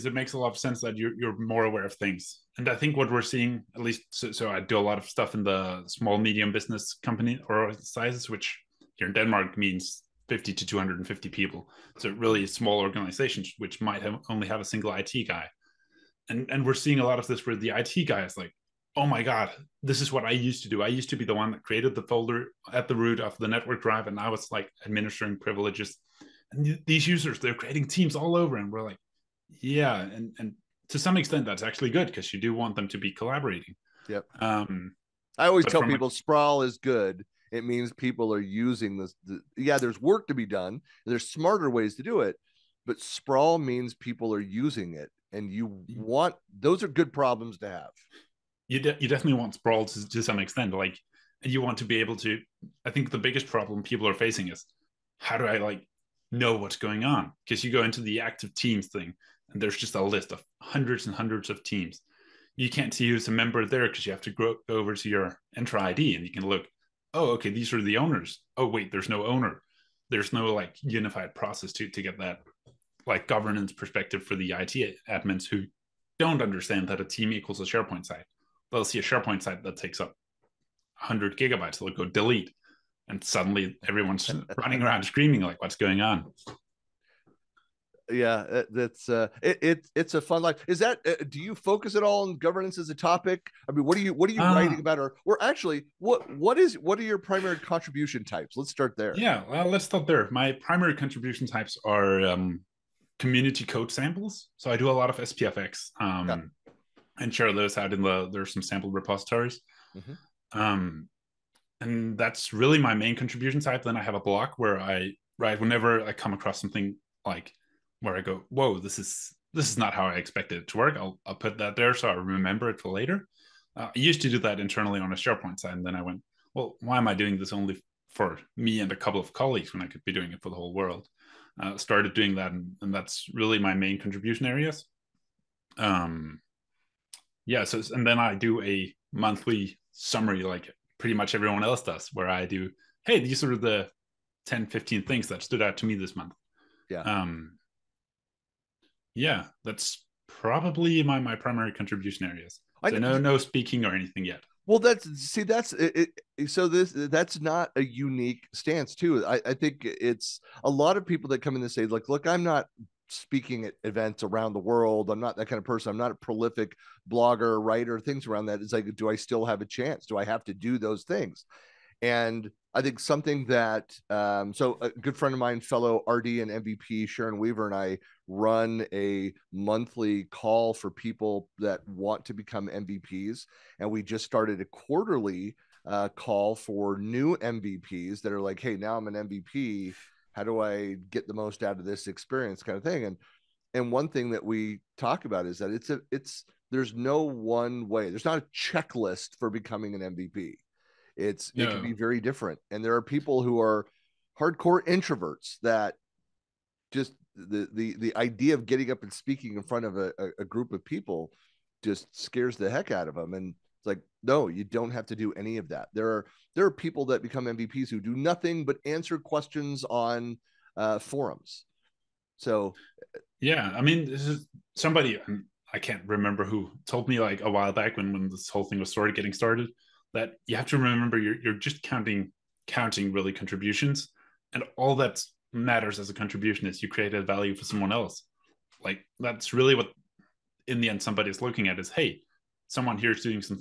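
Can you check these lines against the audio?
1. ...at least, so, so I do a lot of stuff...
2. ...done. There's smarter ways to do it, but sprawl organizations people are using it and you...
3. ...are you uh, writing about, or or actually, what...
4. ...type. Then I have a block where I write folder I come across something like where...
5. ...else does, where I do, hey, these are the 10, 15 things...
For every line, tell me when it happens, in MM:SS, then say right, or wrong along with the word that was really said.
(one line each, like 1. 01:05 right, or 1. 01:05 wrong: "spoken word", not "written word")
1. 00:03 right
2. 00:40 wrong: "means", not "organizations"
3. 01:34 right
4. 01:53 wrong: "whenever", not "folder"
5. 02:21 right.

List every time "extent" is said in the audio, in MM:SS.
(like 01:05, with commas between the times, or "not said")
00:31, 00:50.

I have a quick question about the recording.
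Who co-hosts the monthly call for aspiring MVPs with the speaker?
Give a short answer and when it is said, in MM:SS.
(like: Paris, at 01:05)
Sharon Weaver, at 02:57.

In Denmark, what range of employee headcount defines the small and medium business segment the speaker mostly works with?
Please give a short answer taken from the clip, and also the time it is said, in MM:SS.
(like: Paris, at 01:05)
50 to 250, at 00:10.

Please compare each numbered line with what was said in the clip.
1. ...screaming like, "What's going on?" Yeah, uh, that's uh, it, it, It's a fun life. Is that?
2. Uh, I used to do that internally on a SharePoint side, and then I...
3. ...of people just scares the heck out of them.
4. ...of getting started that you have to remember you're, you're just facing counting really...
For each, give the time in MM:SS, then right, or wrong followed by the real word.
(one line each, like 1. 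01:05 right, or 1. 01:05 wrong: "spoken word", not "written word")
1. 01:25 right
2. 02:03 right
3. 03:30 right
4. 03:49 wrong: "counting", not "facing".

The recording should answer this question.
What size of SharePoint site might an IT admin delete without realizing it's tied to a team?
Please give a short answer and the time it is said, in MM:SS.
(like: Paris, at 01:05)
100 gigabytes, at 01:20.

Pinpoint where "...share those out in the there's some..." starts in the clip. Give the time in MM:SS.
01:47.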